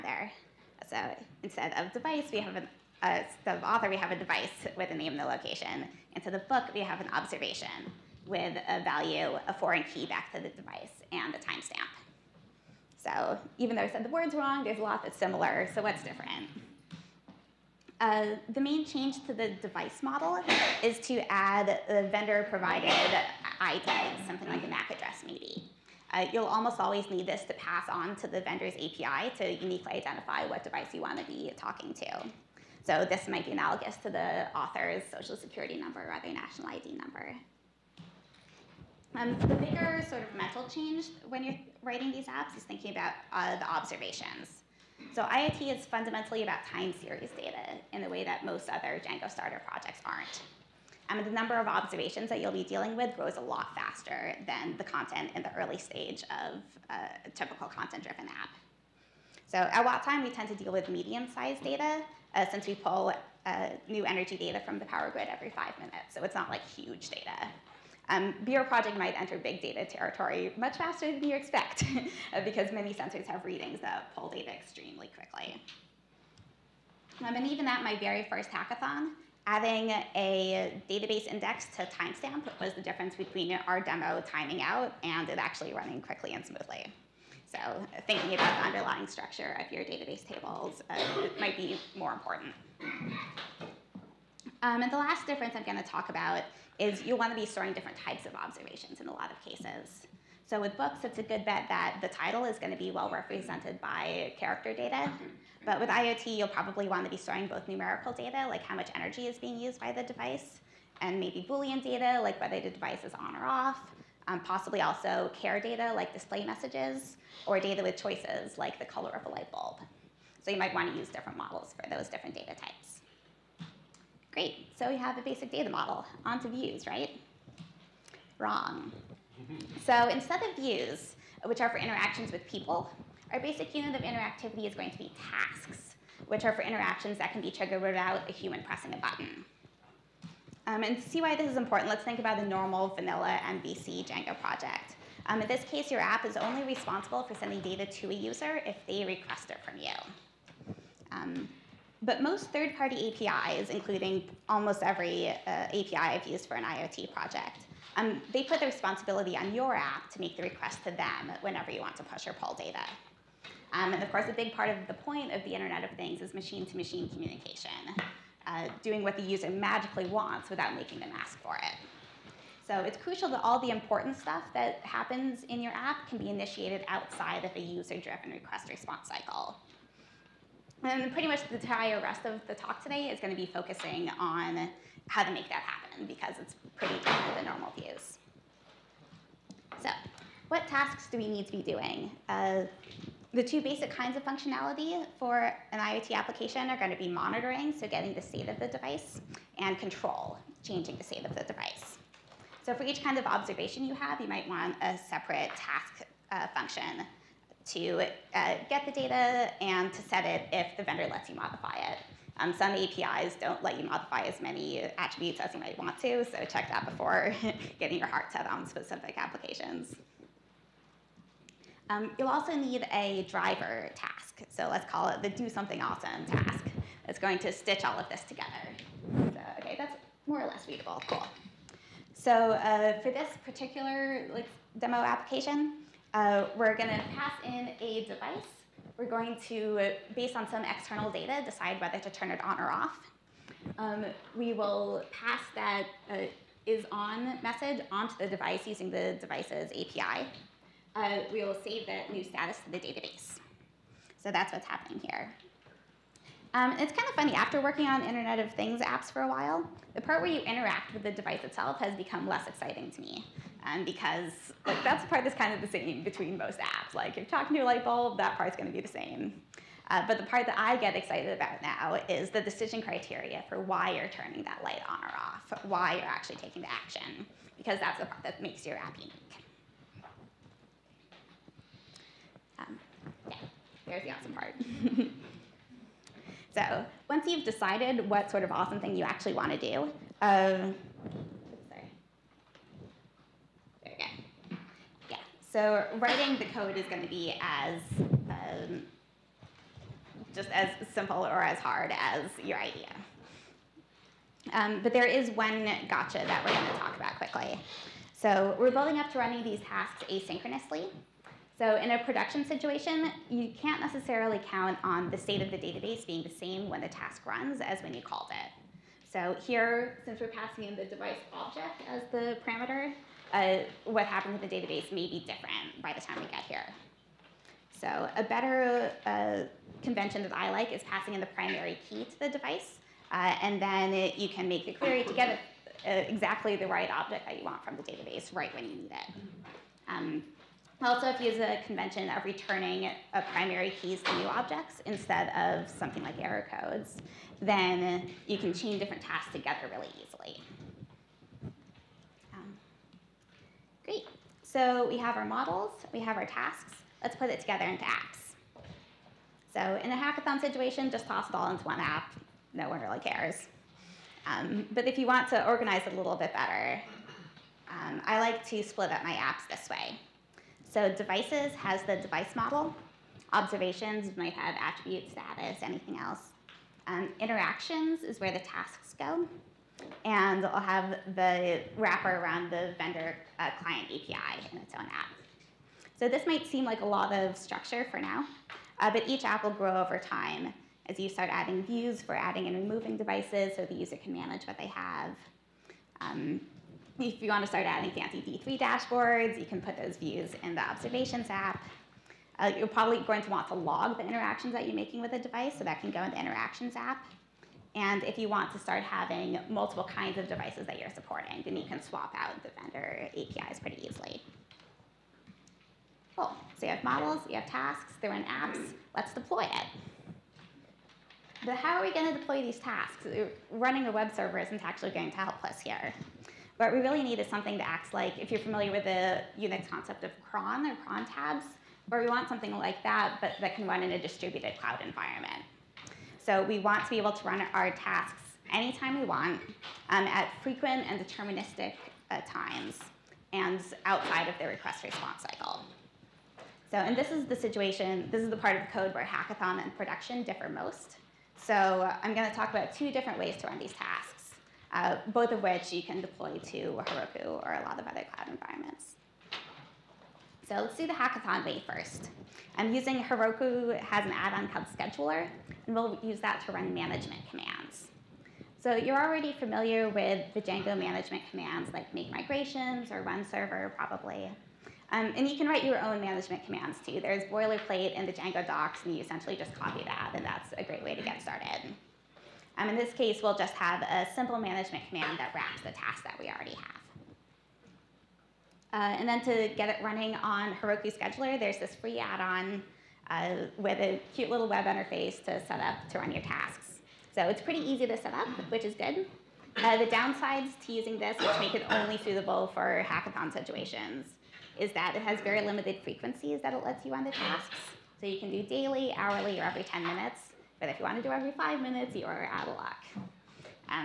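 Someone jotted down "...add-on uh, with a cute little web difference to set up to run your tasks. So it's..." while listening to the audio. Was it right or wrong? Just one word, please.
wrong.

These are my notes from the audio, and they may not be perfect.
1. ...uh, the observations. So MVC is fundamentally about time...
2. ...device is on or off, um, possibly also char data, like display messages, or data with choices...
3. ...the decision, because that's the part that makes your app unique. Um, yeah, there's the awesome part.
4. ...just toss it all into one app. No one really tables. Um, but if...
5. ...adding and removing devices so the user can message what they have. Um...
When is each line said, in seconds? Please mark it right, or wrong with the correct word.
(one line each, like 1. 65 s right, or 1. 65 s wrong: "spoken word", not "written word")
1. 43 s wrong: "IoT", not "MVC"
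2. 112 s right
3. 276 s wrong: "action", not "decision"
4. 360 s wrong: "cares", not "tables"
5. 392 s wrong: "manage", not "message".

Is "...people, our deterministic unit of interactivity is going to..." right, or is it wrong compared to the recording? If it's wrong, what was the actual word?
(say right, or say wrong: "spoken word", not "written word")
wrong: "basic", not "deterministic".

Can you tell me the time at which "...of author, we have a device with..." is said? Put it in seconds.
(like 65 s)
3 s.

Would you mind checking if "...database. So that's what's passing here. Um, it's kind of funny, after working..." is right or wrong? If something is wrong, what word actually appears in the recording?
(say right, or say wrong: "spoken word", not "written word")
wrong: "happening", not "passing".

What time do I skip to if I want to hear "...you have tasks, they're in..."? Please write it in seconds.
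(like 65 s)
417 s.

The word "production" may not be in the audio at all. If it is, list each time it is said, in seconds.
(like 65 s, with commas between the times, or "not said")
312 s, 449 s.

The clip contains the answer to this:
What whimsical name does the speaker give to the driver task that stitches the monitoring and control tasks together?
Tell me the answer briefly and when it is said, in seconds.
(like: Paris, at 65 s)
do something awesome, at 225 s.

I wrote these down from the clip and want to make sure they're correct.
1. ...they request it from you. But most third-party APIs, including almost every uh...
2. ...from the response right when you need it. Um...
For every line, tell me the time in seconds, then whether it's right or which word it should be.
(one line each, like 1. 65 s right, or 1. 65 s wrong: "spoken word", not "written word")
1. 148 s right
2. 337 s wrong: "database", not "response".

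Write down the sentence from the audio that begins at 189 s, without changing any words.
So what tasks do we need to be doing?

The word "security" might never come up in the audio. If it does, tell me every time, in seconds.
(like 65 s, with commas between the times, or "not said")
35 s.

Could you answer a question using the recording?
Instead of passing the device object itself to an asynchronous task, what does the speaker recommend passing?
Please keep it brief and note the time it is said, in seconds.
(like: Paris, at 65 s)
primary key, at 331 s.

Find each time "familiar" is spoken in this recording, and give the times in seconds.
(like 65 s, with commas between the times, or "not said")
428 s, 469 s.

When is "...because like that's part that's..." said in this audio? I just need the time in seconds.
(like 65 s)
263 s.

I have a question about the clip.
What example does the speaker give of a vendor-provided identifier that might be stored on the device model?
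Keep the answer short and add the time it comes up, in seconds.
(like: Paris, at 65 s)
MAC address, at 24 s.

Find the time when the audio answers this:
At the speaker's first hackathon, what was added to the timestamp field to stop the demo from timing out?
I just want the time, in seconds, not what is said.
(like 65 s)
80 s.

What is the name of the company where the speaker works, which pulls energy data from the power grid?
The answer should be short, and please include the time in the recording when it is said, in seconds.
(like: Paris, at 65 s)
WattTime, at 59 s.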